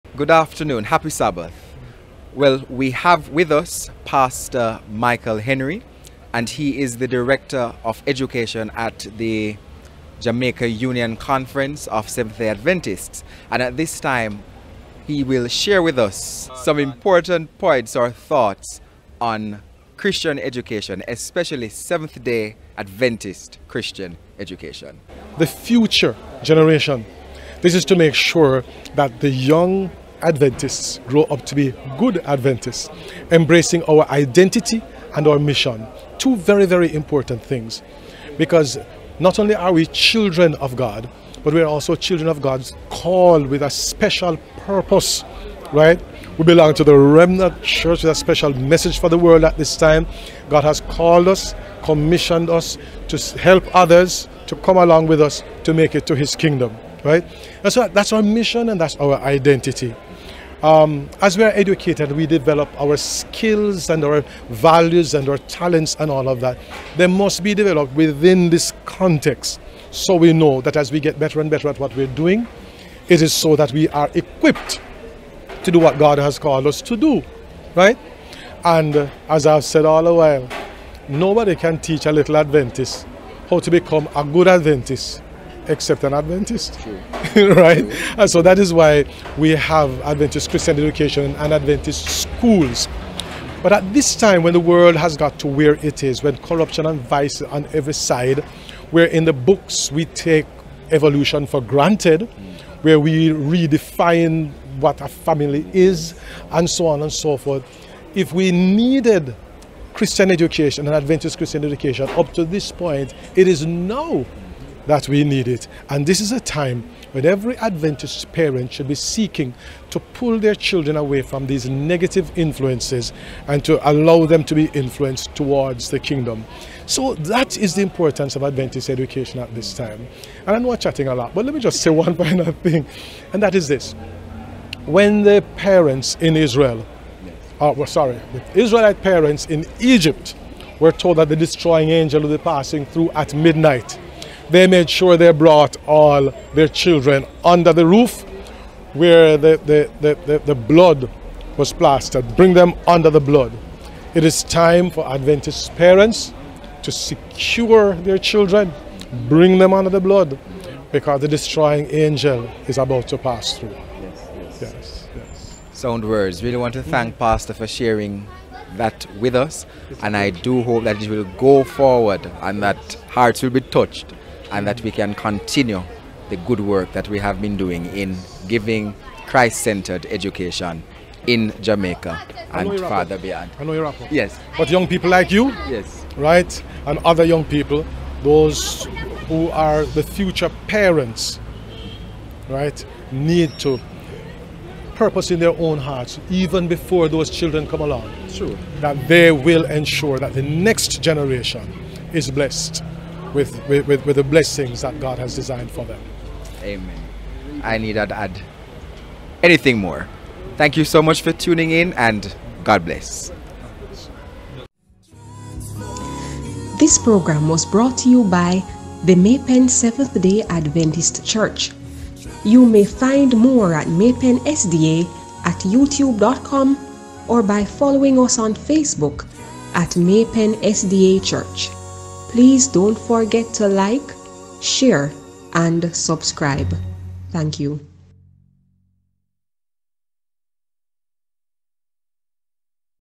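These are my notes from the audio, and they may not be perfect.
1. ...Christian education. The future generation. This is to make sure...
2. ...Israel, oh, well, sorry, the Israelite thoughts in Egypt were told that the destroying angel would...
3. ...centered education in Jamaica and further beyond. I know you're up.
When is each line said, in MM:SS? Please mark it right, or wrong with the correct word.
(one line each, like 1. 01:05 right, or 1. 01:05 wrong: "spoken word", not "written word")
1. 00:23 right
2. 02:16 wrong: "parents", not "thoughts"
3. 02:59 right.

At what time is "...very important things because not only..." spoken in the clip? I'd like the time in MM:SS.
00:36.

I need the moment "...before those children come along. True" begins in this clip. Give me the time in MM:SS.
03:16.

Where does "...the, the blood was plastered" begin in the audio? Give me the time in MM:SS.
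02:30.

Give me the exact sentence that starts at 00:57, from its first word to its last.
That's that's our mission and that's our identity.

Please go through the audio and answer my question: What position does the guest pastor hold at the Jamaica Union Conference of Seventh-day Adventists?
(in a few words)
Director of Education.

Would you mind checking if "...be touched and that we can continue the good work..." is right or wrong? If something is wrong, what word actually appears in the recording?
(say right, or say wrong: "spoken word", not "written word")
right.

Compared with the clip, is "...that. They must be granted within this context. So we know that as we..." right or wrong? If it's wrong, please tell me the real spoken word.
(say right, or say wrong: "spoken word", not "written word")
wrong: "developed", not "granted".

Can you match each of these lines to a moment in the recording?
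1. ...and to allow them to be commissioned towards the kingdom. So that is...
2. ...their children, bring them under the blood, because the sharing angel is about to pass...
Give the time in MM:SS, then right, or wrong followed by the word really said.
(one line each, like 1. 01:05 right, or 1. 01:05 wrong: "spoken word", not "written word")
1. 02:03 wrong: "influenced", not "commissioned"
2. 02:37 wrong: "destroying", not "sharing".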